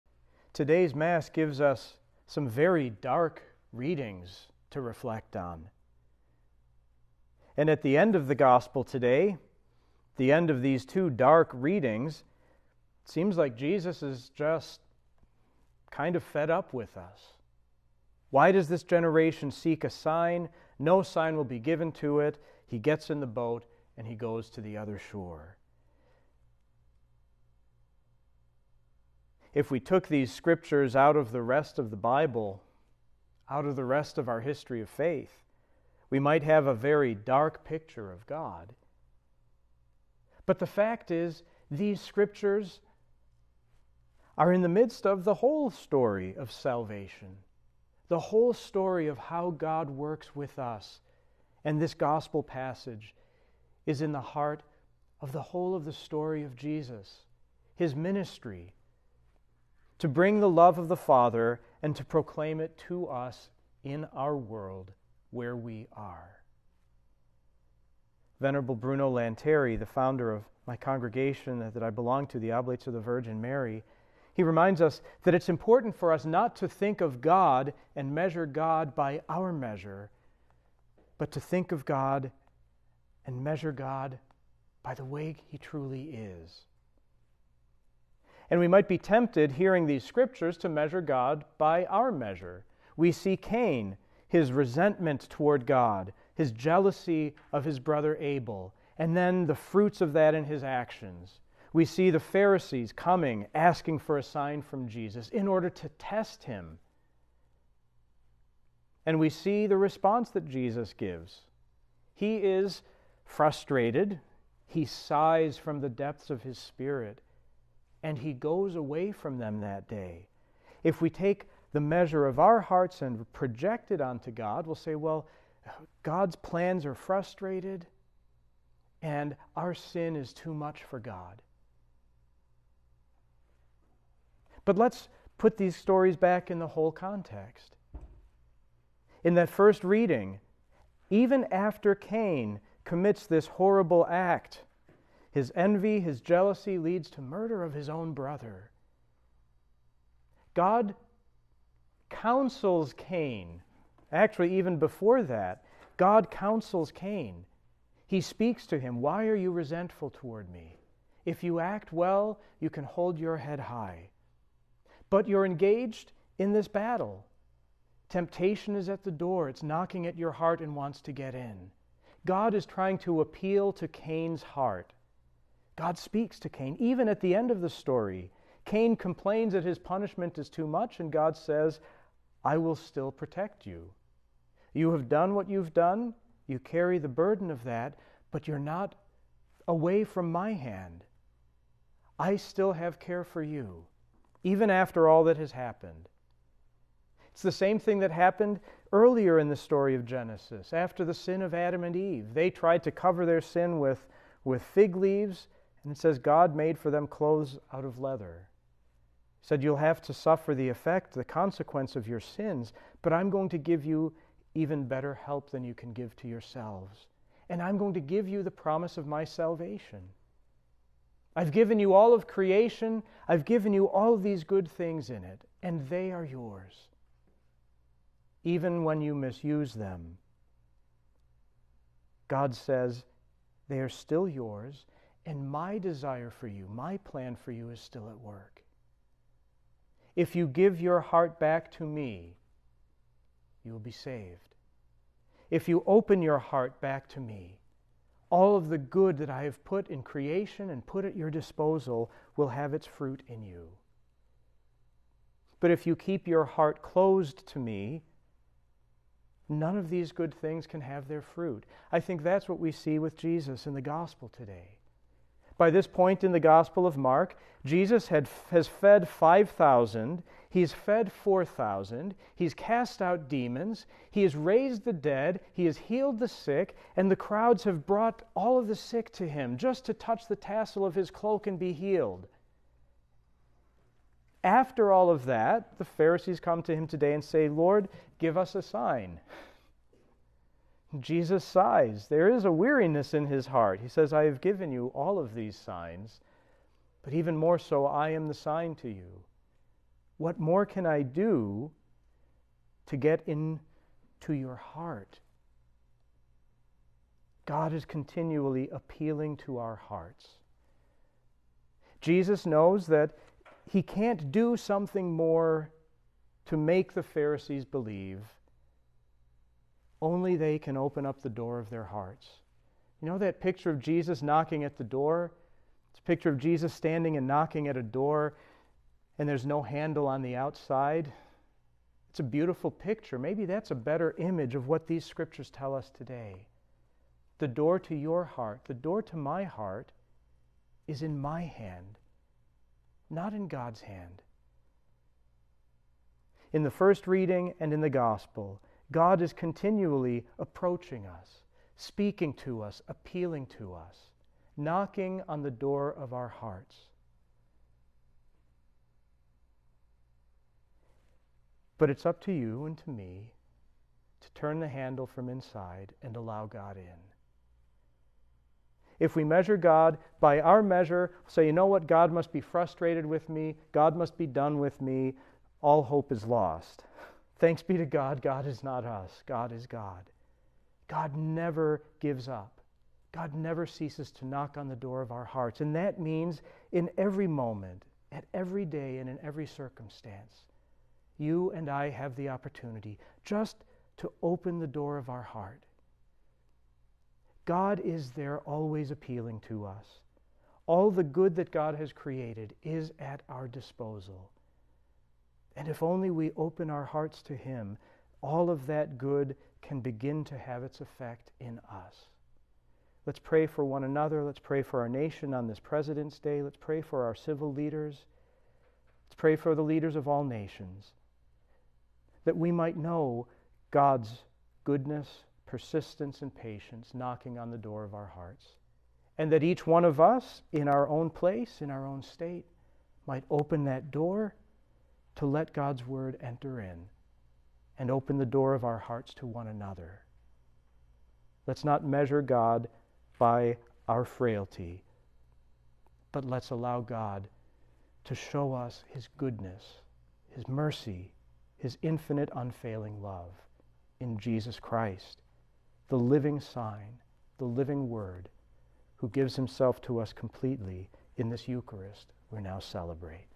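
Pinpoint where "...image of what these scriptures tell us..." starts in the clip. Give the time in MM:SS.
05:34.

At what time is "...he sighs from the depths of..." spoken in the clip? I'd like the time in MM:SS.
01:54.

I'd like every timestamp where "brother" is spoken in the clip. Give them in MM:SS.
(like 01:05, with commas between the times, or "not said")
01:37, 02:28.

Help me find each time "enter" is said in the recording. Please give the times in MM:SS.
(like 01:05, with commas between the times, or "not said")
07:16.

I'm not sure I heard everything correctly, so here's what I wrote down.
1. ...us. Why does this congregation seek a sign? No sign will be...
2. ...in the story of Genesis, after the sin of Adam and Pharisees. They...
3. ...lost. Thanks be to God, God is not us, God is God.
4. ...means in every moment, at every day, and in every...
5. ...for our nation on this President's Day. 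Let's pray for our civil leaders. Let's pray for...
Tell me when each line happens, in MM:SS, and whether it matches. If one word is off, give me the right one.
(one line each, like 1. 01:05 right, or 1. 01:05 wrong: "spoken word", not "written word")
1. 00:16 wrong: "generation", not "congregation"
2. 03:19 wrong: "Eve", not "Pharisees"
3. 06:16 right
4. 06:25 right
5. 06:54 right.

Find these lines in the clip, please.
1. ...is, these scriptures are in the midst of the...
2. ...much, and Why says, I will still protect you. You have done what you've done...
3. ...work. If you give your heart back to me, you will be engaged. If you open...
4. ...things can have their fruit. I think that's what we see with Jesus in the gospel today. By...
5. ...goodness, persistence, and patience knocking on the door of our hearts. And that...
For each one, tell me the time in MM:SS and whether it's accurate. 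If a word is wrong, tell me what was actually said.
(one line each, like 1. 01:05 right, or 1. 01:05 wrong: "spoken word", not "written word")
1. 00:41 right
2. 03:00 wrong: "God", not "Why"
3. 03:58 wrong: "saved", not "engaged"
4. 04:20 right
5. 07:04 right.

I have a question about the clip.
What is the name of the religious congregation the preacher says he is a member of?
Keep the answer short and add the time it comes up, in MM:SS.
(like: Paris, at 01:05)
Oblates of the Virgin Mary, at 01:12.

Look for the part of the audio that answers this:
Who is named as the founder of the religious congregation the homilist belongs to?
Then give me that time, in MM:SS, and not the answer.
01:08.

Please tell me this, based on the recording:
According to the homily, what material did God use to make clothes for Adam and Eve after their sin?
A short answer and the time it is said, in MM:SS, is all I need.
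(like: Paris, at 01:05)
leather, at 03:27.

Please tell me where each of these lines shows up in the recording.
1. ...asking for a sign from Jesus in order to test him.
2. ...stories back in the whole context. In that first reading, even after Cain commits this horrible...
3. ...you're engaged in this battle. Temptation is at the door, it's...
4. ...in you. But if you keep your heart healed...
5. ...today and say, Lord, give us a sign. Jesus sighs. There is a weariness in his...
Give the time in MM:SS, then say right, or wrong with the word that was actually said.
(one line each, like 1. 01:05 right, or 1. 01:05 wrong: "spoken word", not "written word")
1. 01:43 right
2. 02:15 right
3. 02:45 right
4. 04:13 wrong: "closed", not "healed"
5. 04:46 right.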